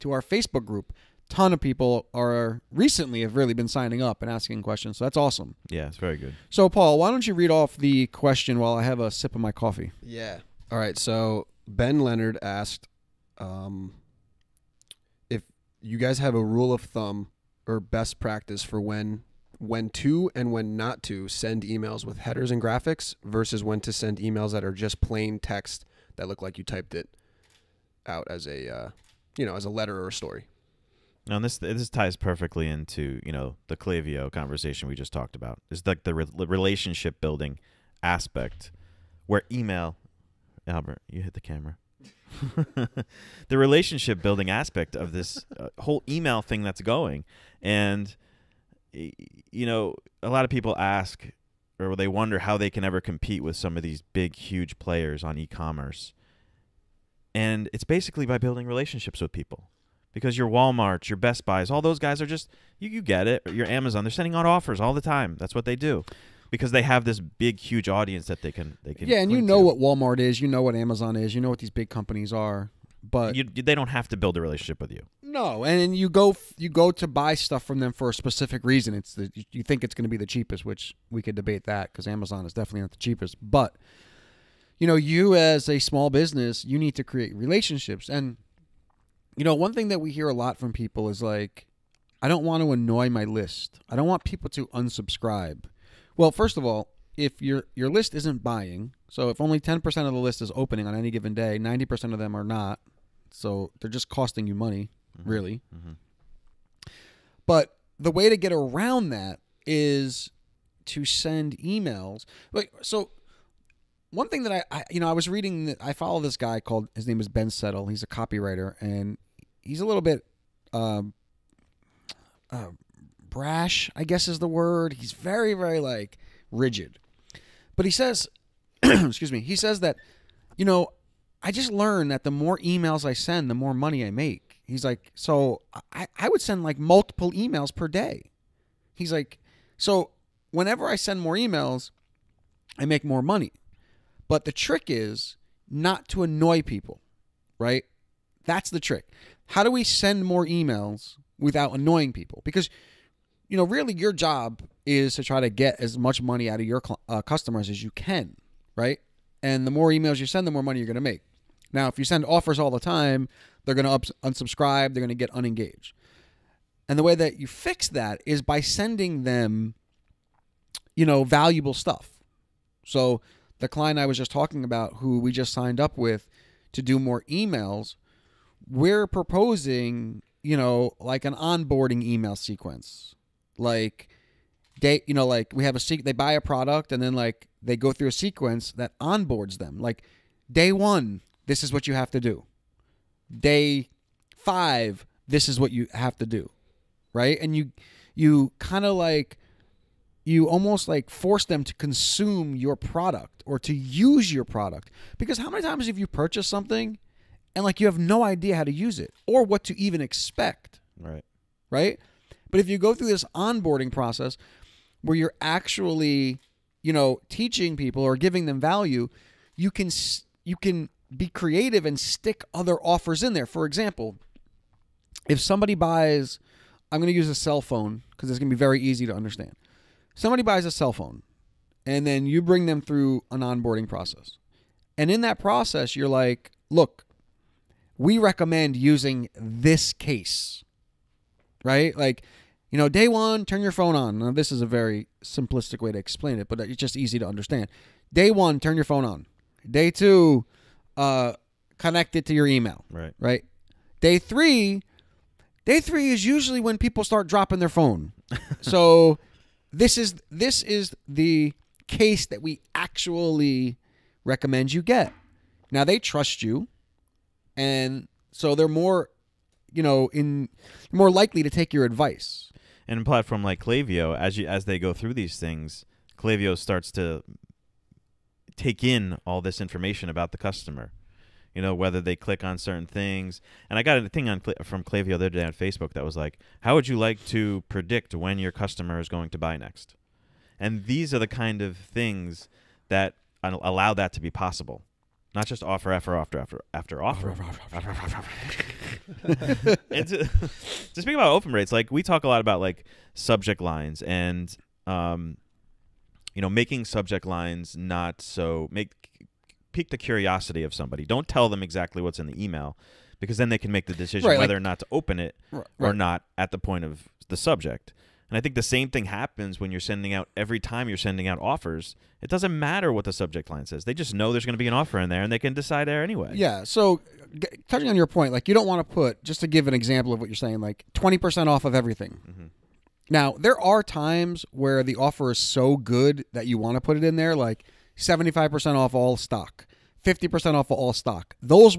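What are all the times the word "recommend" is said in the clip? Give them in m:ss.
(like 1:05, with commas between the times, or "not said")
3:58, 4:24.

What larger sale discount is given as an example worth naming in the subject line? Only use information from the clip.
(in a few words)
75% off all stock.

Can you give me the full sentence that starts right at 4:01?
Like, you know, day one, turn your phone on.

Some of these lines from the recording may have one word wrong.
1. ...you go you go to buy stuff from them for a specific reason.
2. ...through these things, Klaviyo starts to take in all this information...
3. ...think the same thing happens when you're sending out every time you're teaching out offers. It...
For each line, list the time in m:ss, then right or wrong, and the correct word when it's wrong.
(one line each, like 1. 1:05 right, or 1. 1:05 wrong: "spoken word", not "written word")
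1. 1:15 right
2. 4:34 right
3. 5:18 wrong: "sending", not "teaching".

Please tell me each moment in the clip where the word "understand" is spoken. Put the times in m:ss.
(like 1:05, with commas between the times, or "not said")
3:49, 4:07.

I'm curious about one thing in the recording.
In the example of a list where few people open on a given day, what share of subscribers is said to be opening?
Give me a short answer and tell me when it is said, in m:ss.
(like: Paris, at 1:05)
10%, at 1:39.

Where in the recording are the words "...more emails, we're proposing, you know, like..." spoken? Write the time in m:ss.
2:56.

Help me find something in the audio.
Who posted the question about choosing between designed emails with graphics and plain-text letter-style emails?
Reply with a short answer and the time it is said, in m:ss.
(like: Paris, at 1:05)
Ben Leonard, at 0:11.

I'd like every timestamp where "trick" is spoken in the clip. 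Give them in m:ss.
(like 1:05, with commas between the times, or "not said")
2:24, 2:28.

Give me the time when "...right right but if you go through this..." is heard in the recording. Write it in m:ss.
3:30.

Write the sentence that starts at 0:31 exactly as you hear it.
Now this this ties perfectly into you know the Klaviyo conversation we just talked about.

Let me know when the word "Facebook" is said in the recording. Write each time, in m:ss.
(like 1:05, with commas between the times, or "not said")
0:00, 4:45.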